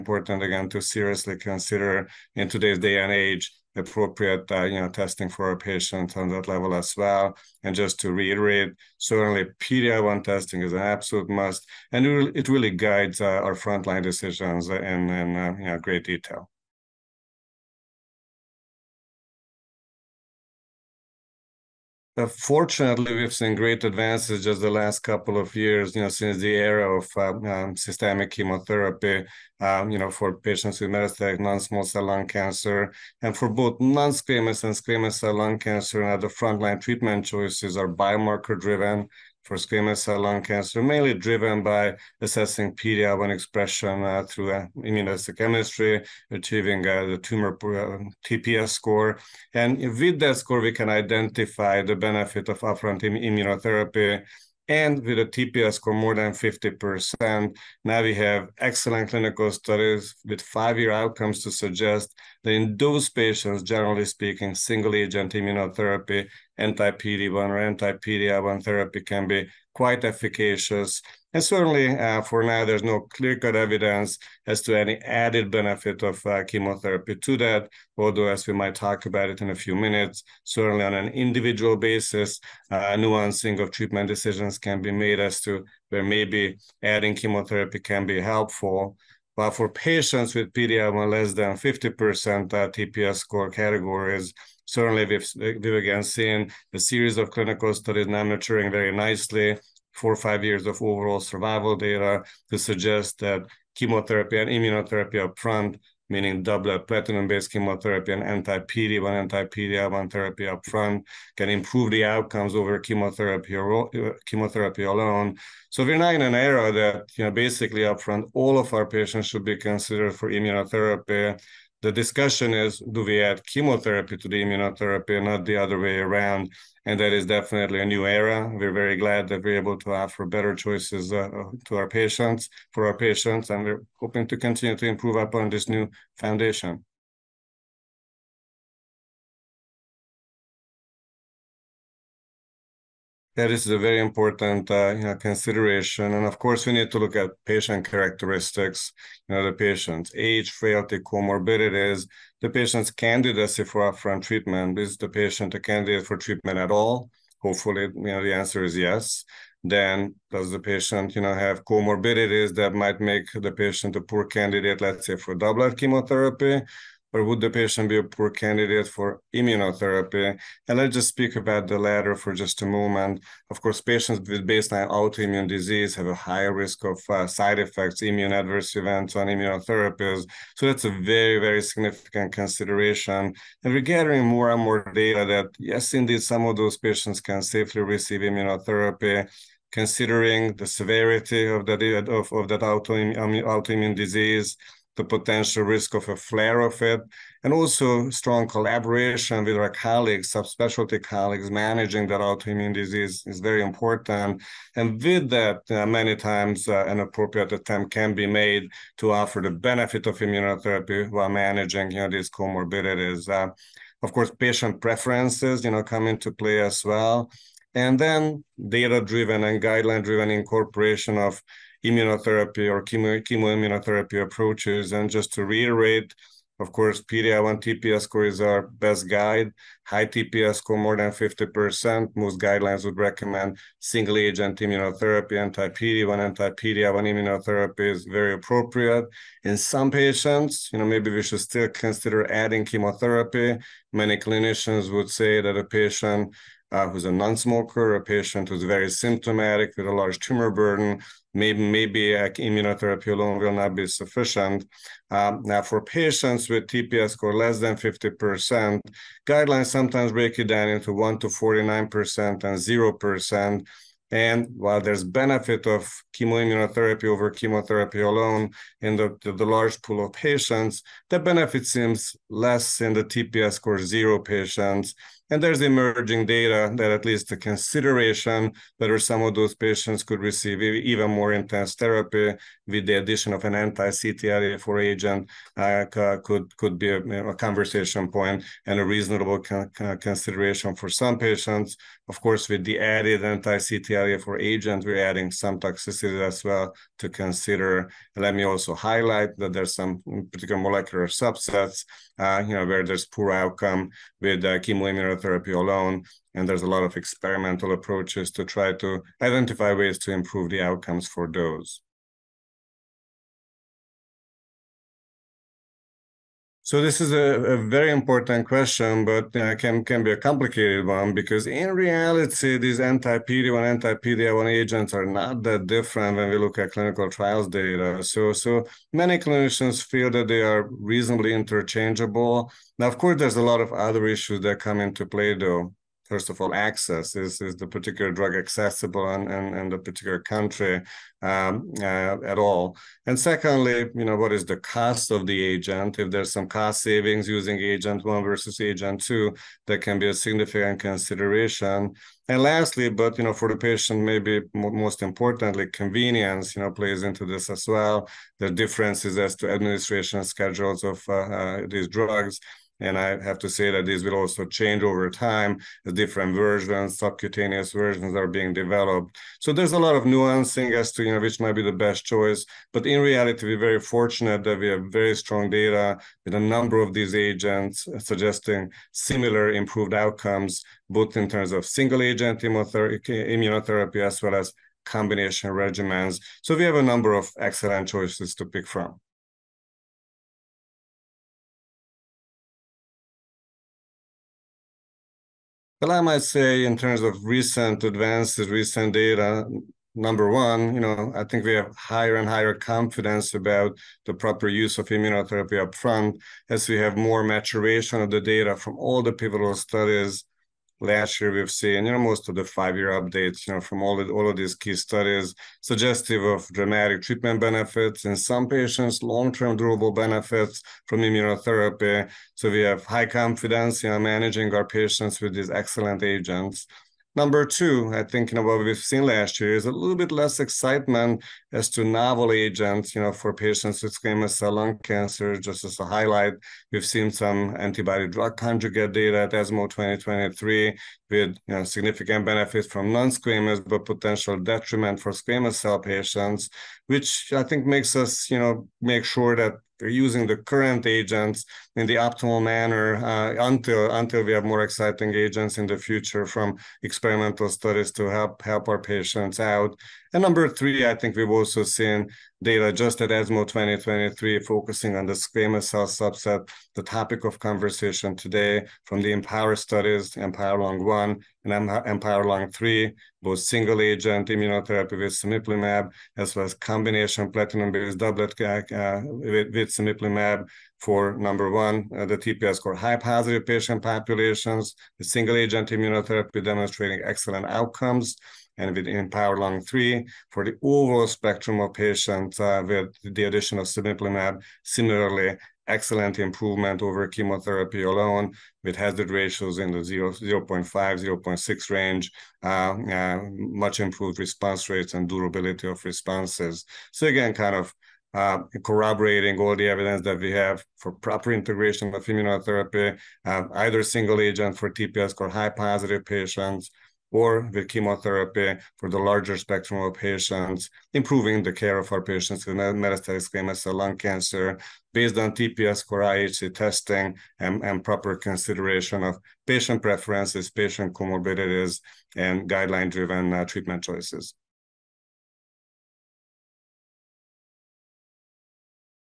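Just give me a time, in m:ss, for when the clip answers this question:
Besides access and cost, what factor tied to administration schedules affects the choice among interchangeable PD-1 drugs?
5:55.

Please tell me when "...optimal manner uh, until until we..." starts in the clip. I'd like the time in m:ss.
7:31.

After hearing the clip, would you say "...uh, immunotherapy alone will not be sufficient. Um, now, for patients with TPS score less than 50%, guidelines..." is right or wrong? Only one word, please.
right.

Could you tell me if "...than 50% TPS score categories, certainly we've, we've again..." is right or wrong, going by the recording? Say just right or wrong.
right.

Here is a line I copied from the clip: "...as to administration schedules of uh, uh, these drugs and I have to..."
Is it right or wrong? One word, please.
right.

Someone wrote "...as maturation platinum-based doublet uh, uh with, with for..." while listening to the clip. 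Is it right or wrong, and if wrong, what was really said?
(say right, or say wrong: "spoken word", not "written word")
wrong: "combination", not "maturation".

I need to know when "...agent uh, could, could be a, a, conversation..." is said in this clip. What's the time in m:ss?
4:44.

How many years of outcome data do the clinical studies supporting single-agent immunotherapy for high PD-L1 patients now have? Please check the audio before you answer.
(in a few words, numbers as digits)
five-year.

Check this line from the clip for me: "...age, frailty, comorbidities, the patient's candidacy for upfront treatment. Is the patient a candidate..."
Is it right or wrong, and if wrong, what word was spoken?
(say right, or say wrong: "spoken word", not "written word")
right.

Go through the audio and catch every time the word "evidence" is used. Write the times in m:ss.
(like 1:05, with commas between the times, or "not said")
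1:13, 8:29.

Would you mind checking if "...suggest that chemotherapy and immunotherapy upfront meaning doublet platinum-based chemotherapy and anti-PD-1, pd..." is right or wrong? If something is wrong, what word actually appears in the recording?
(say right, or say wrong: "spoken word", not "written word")
right.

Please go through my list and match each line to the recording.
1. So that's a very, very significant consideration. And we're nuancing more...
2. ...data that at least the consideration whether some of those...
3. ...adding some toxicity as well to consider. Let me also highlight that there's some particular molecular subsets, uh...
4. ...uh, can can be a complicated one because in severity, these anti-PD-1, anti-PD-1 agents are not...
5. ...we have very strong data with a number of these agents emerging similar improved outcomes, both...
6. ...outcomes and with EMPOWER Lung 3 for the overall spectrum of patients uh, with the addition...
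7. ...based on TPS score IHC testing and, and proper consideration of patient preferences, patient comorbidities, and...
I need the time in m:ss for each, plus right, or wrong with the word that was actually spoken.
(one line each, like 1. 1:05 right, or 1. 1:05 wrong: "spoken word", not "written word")
1. 3:00 wrong: "gathering", not "nuancing"
2. 4:36 right
3. 4:55 right
4. 5:19 wrong: "reality", not "severity"
5. 6:14 wrong: "suggesting", not "emerging"
6. 8:07 right
7. 8:44 right.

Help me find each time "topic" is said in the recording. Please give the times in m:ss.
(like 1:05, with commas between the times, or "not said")
7:46.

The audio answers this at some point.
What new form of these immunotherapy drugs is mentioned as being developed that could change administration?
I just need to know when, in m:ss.
6:06.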